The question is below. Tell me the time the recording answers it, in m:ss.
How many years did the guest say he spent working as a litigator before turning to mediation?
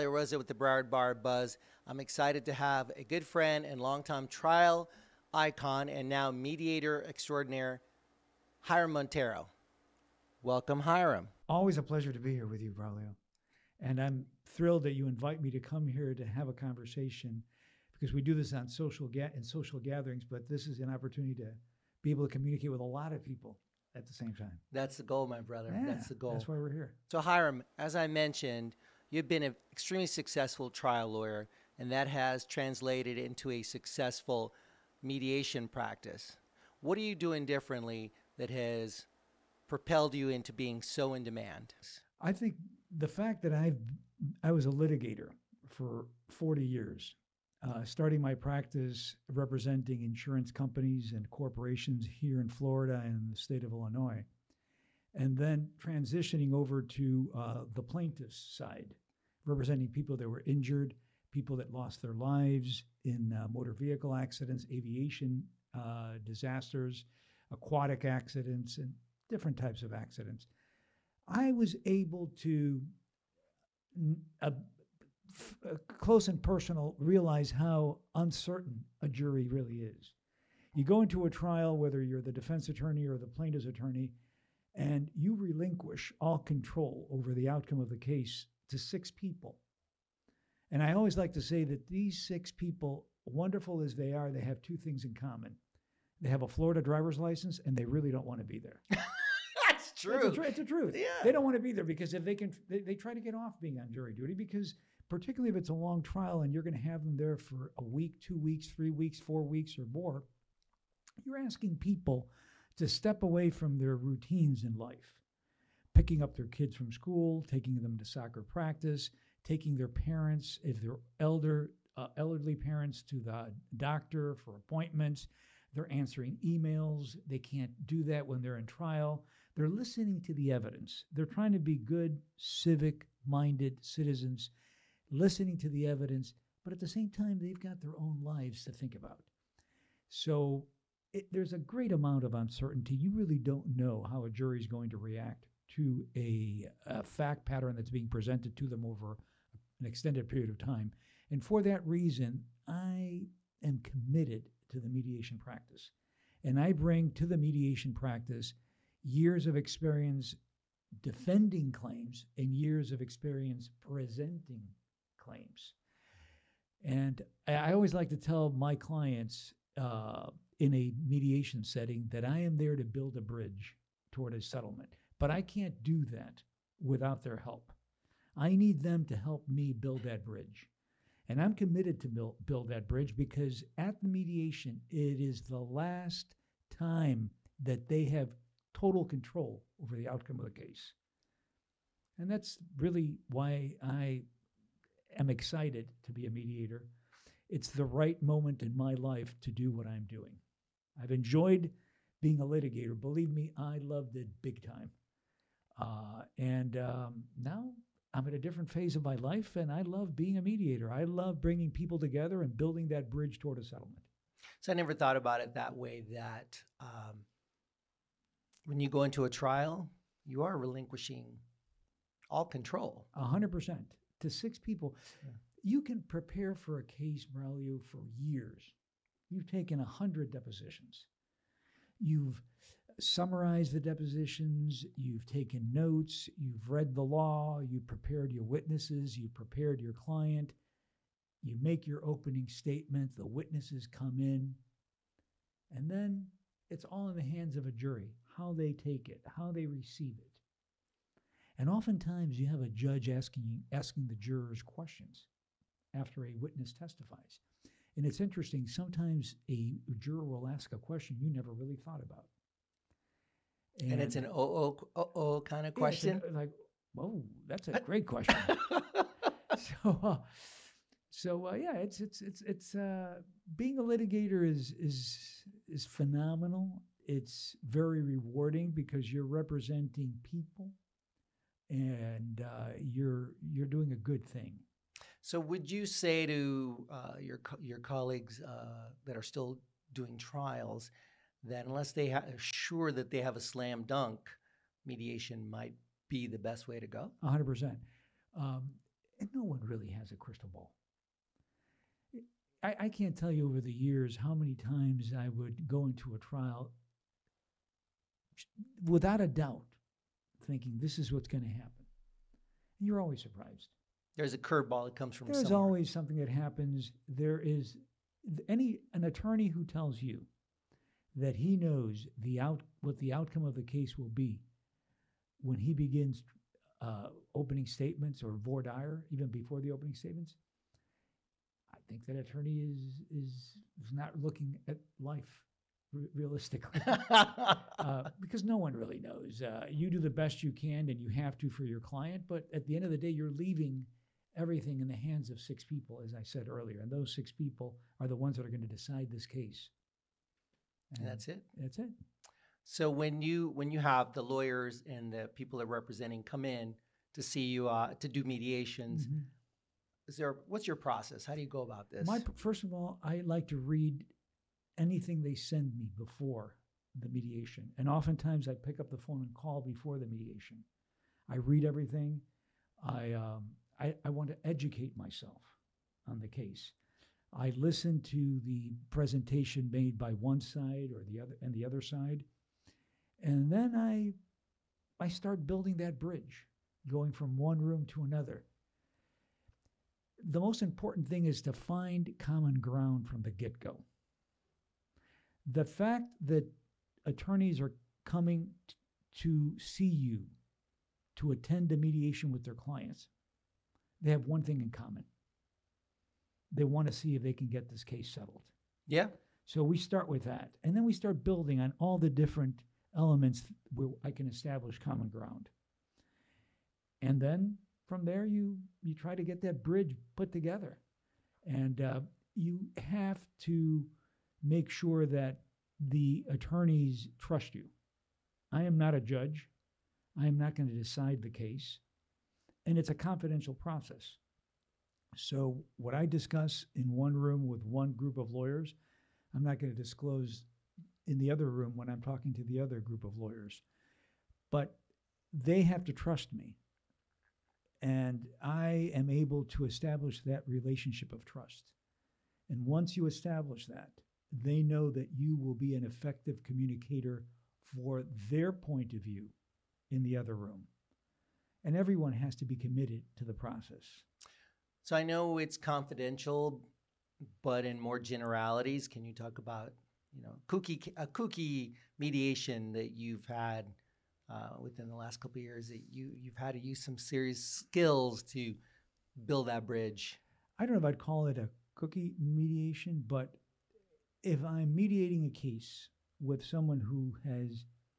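0:46.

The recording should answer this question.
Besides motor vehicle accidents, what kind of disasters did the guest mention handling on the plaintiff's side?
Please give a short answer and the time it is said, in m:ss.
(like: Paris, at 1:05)
aviation, at 1:04.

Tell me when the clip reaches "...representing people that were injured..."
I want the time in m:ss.
0:59.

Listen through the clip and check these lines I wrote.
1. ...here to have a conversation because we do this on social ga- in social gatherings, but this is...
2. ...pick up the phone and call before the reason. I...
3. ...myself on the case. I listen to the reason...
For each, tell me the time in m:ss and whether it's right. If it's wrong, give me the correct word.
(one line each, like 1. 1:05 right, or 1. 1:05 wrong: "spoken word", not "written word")
1. 0:15 right
2. 6:08 wrong: "mediation", not "reason"
3. 6:14 wrong: "presentation", not "reason".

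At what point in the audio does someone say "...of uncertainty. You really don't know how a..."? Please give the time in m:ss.
2:22.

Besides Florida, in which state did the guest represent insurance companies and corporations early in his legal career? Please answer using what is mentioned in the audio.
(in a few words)
Illinois.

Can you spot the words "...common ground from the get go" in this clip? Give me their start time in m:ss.
6:32.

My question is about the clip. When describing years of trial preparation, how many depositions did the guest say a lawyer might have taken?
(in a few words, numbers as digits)
100.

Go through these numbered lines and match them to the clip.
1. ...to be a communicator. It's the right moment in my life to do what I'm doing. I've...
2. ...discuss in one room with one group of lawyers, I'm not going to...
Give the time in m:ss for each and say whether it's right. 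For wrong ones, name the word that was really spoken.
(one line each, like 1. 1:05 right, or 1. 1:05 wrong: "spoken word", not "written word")
1. 3:16 wrong: "mediator", not "communicator"
2. 7:16 right.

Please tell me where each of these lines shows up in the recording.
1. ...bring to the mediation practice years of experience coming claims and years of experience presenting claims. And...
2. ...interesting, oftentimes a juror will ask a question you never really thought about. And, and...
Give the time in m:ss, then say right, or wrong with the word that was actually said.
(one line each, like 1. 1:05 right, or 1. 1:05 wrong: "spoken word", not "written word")
1. 2:36 wrong: "defending", not "coming"
2. 4:18 wrong: "sometimes", not "oftentimes".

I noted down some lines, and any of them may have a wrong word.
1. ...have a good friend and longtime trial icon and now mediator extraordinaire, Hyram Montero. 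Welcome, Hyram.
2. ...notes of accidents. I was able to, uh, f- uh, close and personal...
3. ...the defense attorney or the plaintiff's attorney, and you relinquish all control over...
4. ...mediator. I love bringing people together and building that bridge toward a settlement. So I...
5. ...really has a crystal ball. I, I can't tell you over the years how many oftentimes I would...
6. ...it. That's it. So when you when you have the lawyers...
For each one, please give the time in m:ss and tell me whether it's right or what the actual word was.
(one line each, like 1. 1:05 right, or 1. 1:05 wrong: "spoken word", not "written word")
1. 0:02 right
2. 1:09 wrong: "types", not "notes"
3. 1:22 right
4. 3:30 right
5. 4:59 wrong: "times", not "oftentimes"
6. 5:51 right.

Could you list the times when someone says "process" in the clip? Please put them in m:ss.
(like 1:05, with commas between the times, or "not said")
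6:00, 7:13, 7:43.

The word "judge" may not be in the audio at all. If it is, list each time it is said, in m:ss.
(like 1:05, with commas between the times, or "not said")
4:12, 7:09.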